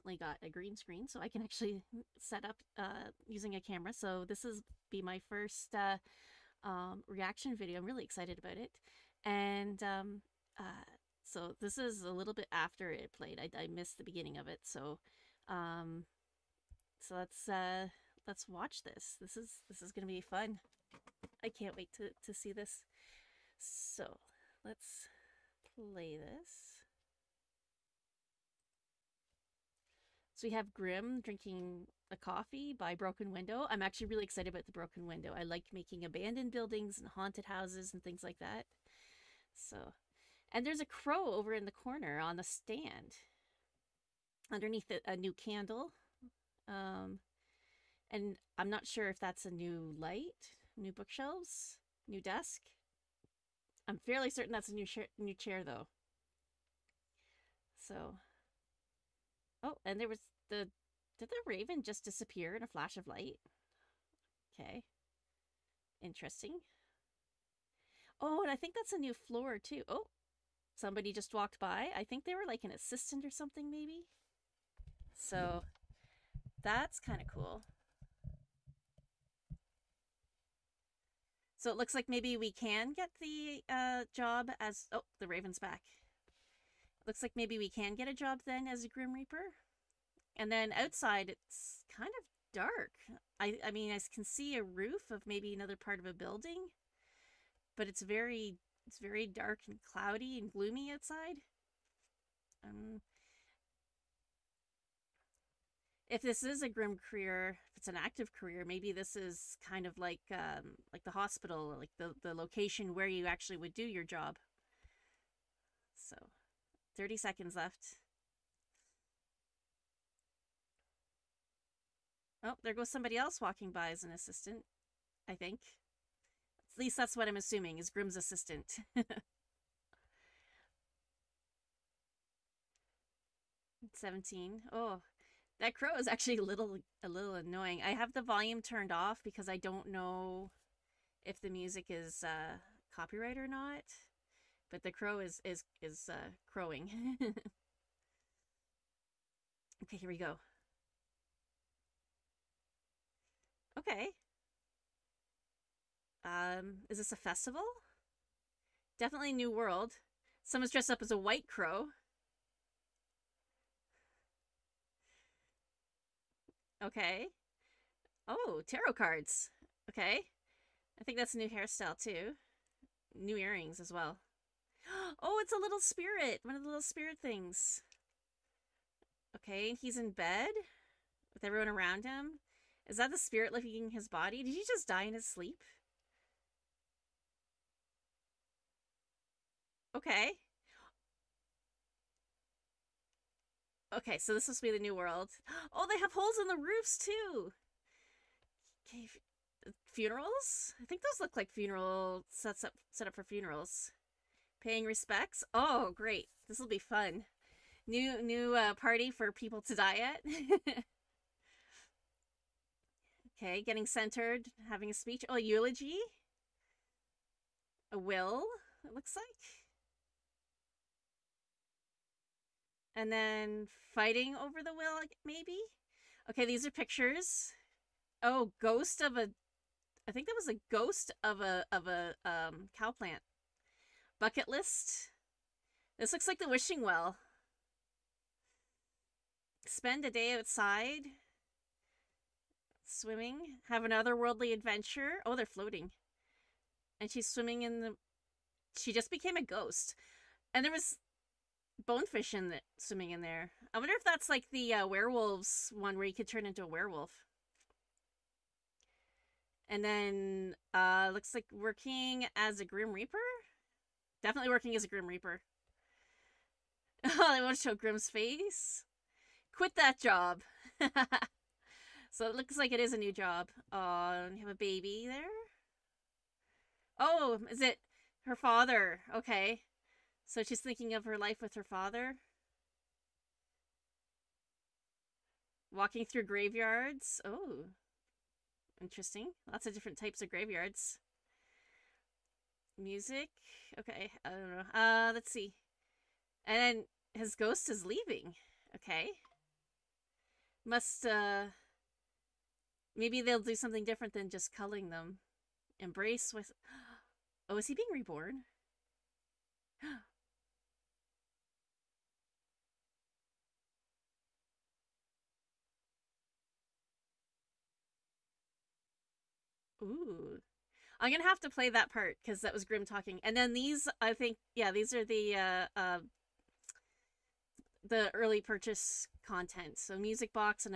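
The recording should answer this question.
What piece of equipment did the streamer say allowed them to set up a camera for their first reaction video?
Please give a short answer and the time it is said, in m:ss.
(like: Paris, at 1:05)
green screen, at 0:00.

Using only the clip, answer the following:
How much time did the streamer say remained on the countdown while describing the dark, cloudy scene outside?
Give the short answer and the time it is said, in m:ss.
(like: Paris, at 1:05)
30 seconds, at 1:56.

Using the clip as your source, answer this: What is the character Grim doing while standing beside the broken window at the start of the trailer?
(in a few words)
drinking a coffee.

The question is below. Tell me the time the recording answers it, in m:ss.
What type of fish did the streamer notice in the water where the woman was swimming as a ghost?
4:11.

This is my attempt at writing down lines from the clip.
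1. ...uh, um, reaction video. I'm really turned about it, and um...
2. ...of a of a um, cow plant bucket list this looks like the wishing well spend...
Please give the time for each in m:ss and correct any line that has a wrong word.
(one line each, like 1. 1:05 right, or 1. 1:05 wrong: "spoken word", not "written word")
1. 0:05 wrong: "excited", not "turned"
2. 3:51 right.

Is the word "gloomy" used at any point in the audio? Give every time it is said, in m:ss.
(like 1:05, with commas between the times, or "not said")
1:40.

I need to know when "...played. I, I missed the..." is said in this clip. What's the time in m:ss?
0:13.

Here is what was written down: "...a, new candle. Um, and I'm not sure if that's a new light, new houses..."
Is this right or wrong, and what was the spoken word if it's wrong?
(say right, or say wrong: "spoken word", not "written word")
wrong: "bookshelves", not "houses".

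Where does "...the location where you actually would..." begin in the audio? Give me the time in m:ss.
1:52.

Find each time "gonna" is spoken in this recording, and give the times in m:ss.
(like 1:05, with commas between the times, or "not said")
0:19, 5:21.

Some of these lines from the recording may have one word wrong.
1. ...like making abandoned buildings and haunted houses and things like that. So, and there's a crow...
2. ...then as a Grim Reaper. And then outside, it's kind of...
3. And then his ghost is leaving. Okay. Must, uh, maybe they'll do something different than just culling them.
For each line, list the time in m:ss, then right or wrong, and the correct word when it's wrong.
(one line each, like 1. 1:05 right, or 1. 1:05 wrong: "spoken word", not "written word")
1. 0:35 right
2. 1:28 right
3. 4:56 right.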